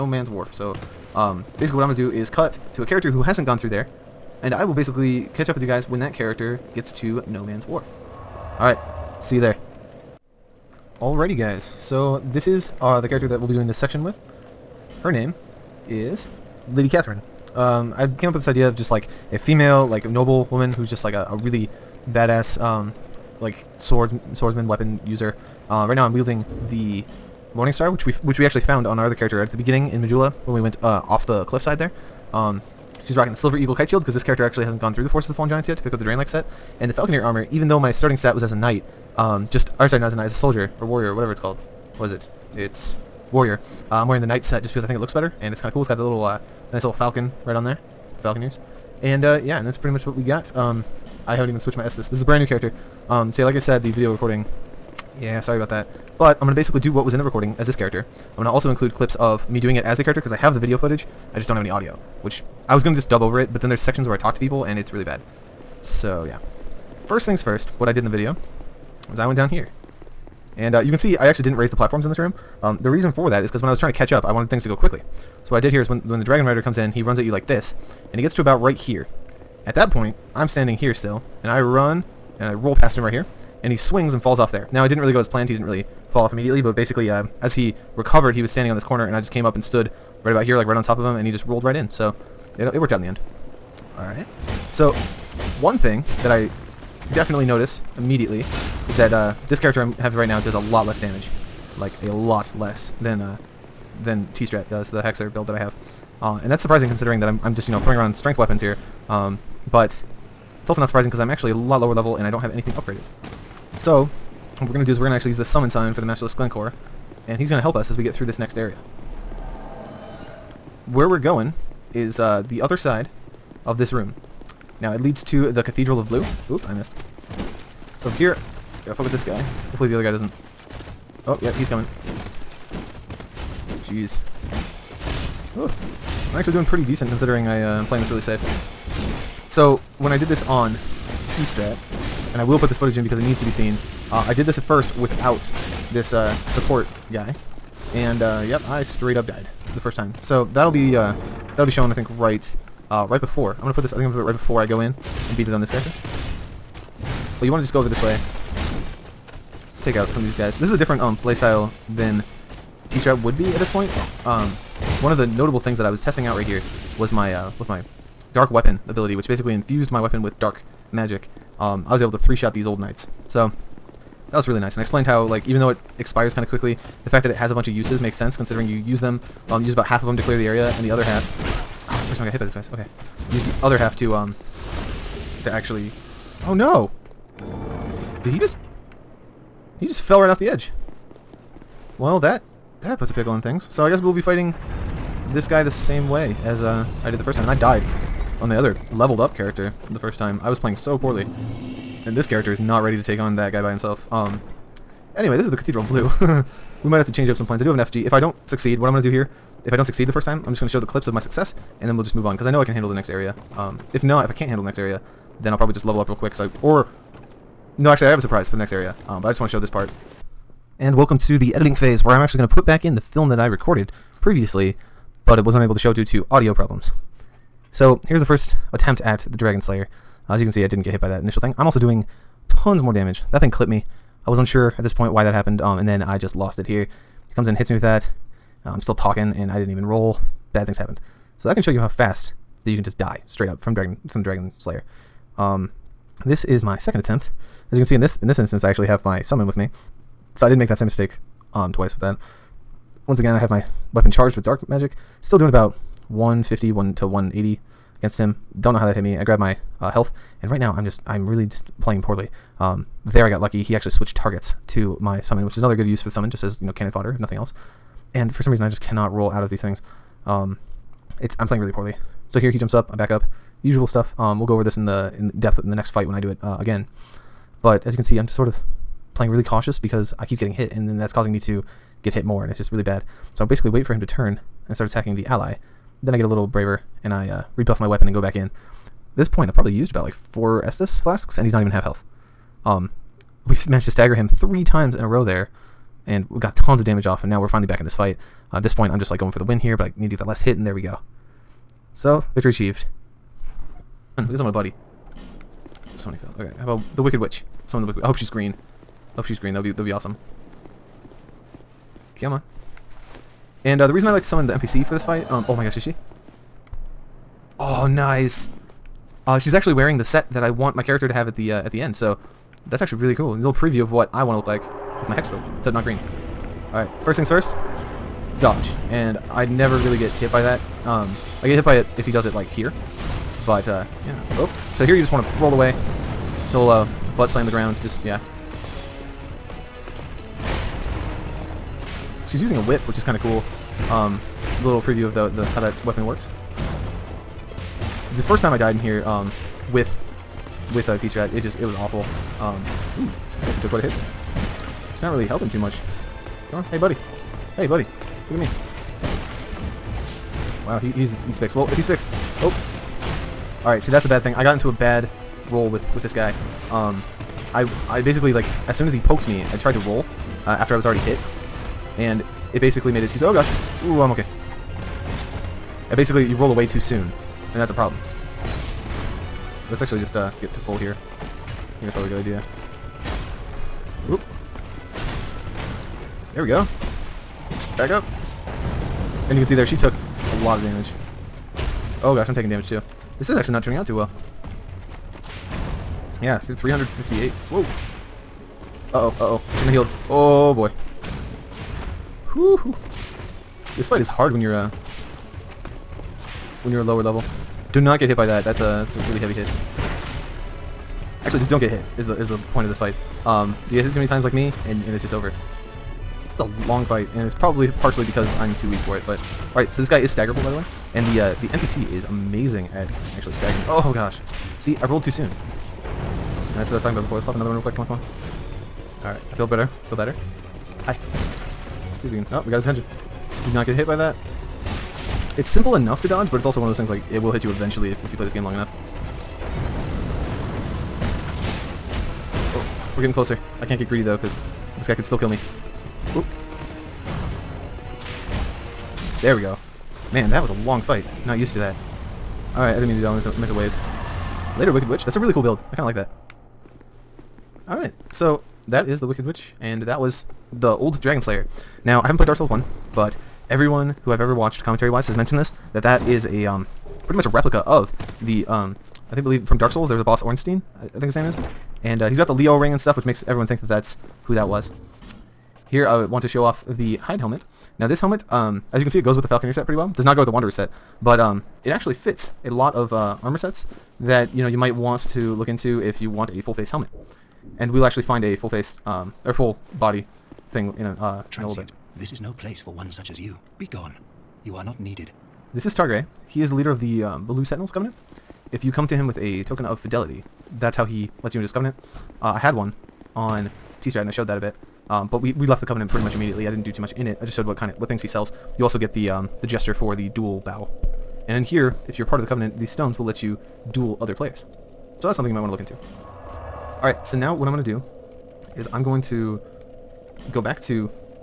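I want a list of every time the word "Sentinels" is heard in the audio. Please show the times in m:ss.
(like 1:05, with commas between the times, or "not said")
8:17.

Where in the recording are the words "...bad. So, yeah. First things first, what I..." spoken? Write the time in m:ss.
1:05.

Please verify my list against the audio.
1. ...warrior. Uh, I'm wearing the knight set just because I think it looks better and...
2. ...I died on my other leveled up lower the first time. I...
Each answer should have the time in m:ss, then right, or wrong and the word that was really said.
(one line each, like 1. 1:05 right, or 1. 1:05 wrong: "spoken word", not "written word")
1. 0:43 right
2. 3:17 wrong: "character", not "lower".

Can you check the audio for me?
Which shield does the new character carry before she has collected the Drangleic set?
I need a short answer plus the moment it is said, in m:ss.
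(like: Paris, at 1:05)
Silver Eagle Kite Shield, at 0:33.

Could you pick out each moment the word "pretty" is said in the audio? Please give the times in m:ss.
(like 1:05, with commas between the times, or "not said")
0:49, 2:16, 7:47, 7:59, 8:25.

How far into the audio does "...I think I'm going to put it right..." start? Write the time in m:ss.
2:33.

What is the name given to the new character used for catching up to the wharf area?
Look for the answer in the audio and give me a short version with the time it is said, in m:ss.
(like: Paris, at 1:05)
Lady Catherine, at 0:16.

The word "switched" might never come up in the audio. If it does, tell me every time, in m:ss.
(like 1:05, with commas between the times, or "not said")
0:51, 4:23.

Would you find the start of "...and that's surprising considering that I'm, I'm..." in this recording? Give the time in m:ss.
1:46.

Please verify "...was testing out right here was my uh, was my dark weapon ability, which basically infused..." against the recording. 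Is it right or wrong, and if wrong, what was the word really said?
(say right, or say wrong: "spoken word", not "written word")
right.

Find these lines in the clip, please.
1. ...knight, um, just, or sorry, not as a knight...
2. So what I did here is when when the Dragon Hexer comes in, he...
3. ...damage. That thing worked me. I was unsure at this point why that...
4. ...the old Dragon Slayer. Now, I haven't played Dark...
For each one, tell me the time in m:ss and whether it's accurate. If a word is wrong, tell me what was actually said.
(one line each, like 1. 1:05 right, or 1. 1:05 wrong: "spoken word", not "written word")
1. 0:38 right
2. 1:15 wrong: "Rider", not "Hexer"
3. 3:52 wrong: "clipped", not "worked"
4. 7:40 right.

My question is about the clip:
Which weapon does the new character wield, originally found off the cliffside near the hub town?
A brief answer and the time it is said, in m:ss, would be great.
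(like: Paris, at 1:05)
Morningstar, at 0:27.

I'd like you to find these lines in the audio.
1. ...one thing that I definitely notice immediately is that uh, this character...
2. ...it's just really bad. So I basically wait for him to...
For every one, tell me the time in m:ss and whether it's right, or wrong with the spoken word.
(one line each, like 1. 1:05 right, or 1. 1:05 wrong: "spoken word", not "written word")
1. 1:35 right
2. 4:42 right.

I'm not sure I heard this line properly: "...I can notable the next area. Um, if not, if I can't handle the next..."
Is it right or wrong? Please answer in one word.
wrong.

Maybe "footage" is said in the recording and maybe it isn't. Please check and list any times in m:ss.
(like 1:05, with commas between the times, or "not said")
1:00, 2:22.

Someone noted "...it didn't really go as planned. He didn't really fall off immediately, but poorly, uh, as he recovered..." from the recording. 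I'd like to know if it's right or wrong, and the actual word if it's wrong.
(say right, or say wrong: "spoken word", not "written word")
wrong: "basically", not "poorly".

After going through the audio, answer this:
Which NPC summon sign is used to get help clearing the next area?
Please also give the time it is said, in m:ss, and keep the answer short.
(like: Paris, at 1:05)
Masterless Glencour, at 1:56.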